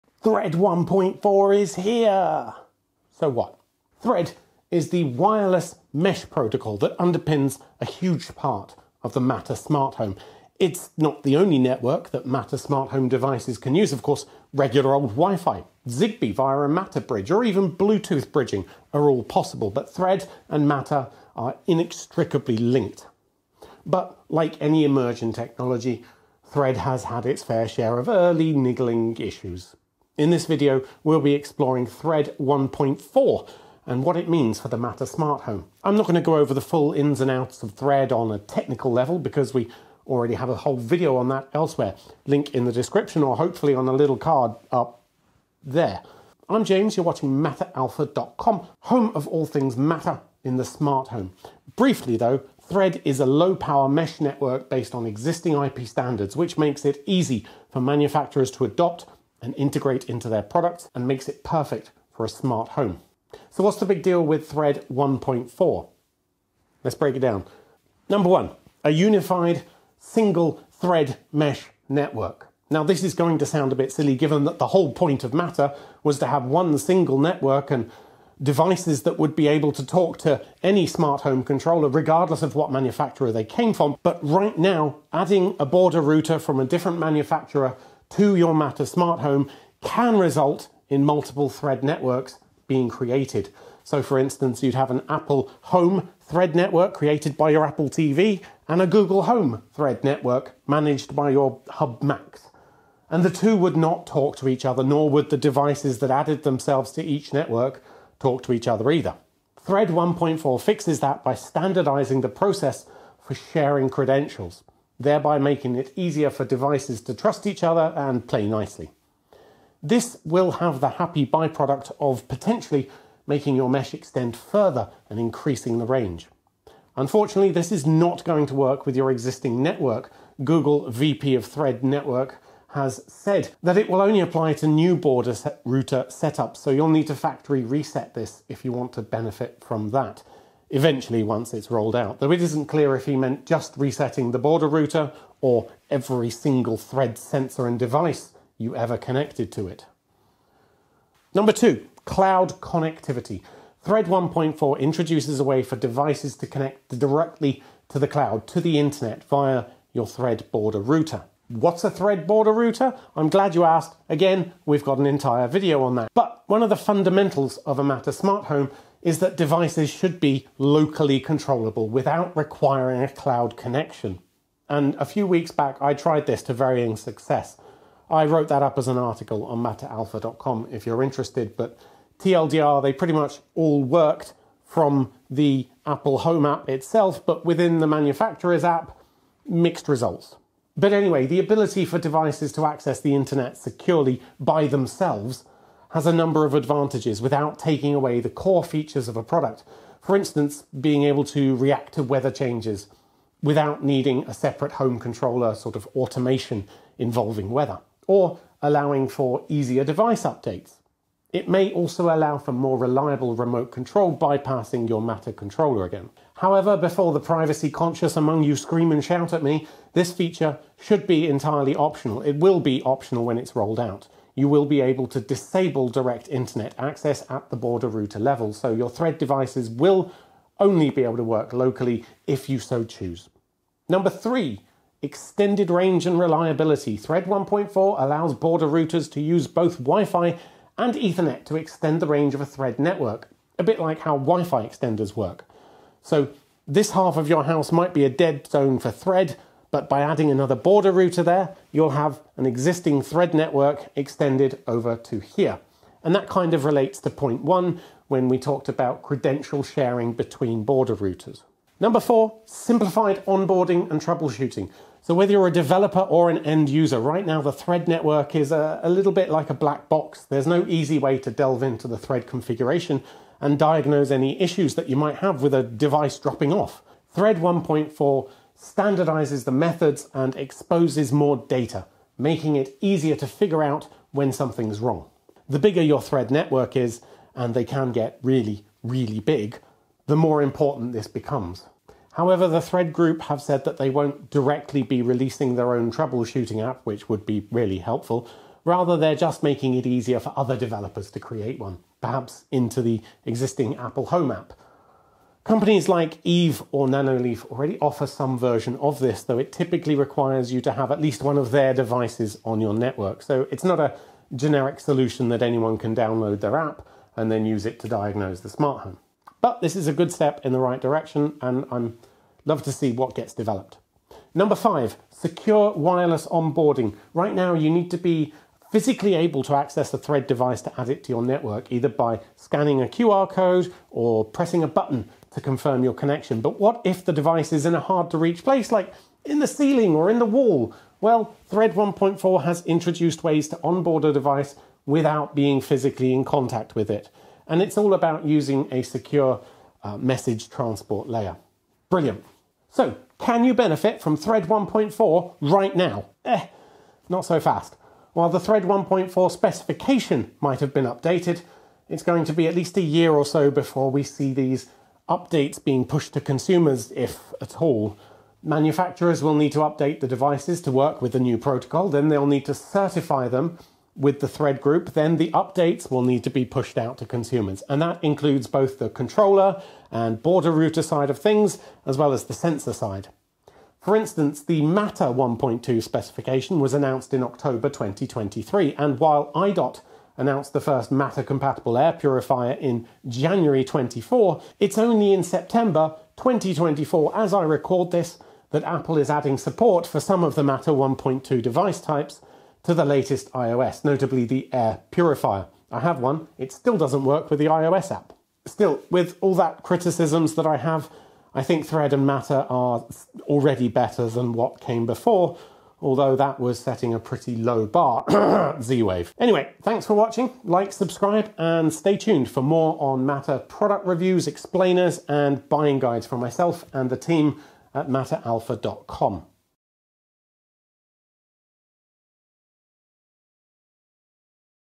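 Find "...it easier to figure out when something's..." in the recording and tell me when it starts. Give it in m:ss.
4:42.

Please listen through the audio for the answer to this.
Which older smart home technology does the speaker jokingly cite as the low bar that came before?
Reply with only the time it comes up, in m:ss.
6:58.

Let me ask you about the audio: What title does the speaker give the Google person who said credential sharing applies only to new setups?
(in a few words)
VP of Thread Network.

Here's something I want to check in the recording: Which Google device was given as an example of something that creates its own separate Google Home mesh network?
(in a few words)
Hub Max.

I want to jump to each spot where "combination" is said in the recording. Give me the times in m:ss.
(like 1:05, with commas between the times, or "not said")
not said.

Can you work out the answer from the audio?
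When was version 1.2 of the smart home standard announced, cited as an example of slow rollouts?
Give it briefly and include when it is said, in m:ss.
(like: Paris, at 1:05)
October 2023, at 6:27.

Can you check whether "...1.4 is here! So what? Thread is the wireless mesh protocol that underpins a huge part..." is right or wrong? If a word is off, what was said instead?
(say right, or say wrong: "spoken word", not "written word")
right.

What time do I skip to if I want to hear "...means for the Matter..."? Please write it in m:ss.
0:34.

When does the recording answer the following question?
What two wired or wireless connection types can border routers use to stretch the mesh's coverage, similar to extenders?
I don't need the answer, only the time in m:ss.
3:59.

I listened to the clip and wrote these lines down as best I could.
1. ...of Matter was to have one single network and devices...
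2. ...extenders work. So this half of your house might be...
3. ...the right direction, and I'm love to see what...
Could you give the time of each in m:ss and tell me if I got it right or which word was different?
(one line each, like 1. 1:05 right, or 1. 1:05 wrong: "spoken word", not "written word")
1. 1:15 right
2. 4:04 right
3. 5:20 right.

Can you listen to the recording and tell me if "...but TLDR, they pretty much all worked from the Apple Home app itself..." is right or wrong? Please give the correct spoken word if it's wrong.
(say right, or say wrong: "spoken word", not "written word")
right.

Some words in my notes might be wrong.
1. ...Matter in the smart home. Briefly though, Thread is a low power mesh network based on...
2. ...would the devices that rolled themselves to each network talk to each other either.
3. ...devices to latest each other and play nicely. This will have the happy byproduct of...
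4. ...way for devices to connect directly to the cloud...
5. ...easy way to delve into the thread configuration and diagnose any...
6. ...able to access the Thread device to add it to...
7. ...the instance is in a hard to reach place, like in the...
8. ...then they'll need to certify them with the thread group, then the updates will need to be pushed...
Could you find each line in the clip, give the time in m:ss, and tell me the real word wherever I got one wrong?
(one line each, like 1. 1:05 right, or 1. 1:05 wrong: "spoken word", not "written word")
1. 0:49 right
2. 1:45 wrong: "added", not "rolled"
3. 1:56 wrong: "trust", not "latest"
4. 2:35 right
5. 4:30 right
6. 5:29 right
7. 5:37 wrong: "device", not "instance"
8. 6:11 right.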